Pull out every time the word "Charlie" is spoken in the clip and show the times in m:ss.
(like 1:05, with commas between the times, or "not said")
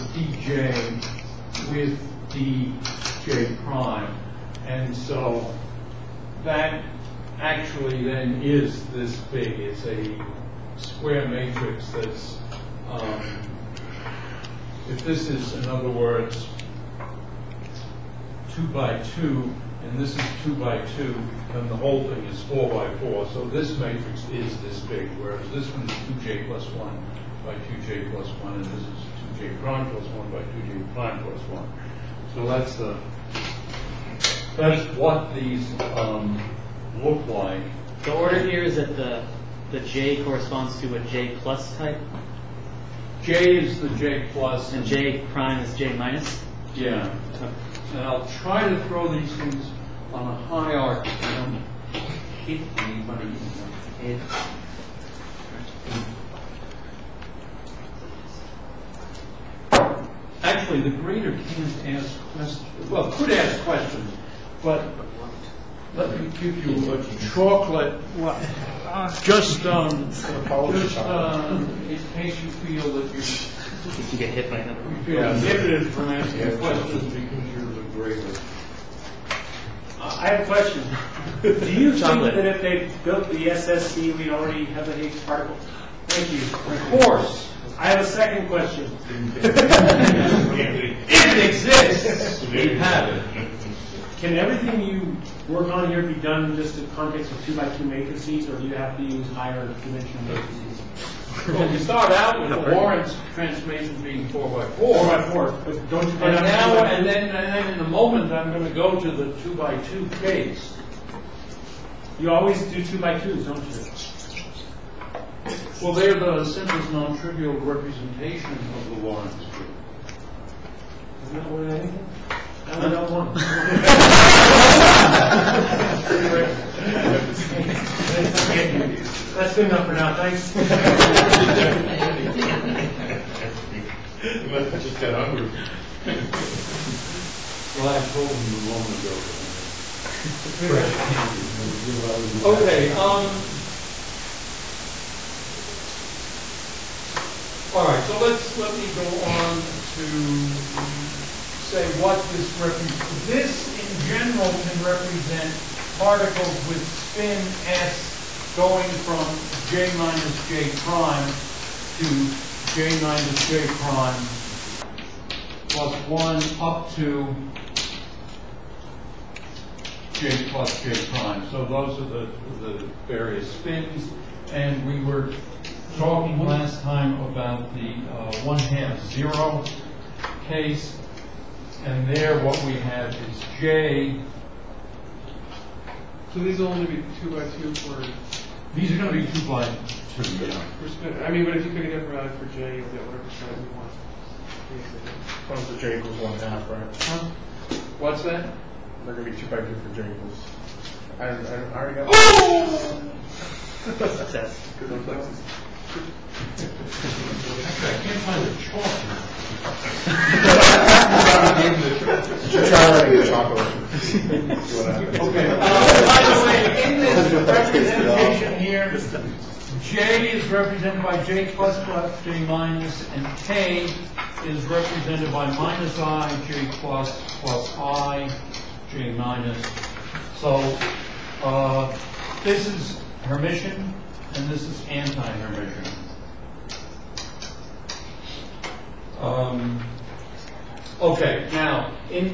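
3:32.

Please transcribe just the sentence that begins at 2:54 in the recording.
And we were talking last time about the uh, 1 half 0 case.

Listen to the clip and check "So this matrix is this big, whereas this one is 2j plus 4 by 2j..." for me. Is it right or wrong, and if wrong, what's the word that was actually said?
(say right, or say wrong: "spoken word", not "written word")
wrong: "1", not "4".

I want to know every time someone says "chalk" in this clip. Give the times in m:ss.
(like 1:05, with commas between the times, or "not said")
3:28, 3:34.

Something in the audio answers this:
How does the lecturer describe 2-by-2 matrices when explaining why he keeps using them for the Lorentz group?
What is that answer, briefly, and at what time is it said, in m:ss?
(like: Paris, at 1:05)
simplest non-trivial representation, at 1:56.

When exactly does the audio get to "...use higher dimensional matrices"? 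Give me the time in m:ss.
1:39.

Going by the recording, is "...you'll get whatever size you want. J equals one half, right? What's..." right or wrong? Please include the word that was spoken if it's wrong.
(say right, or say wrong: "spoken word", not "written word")
right.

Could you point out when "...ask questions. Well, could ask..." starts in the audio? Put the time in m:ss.
1:01.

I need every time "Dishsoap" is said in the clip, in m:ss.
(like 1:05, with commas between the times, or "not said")
not said.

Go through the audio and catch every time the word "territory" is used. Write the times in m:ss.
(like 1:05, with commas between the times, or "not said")
not said.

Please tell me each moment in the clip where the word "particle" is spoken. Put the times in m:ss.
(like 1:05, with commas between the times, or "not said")
1:25, 2:35.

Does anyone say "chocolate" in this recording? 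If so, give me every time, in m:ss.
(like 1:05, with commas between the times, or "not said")
1:07.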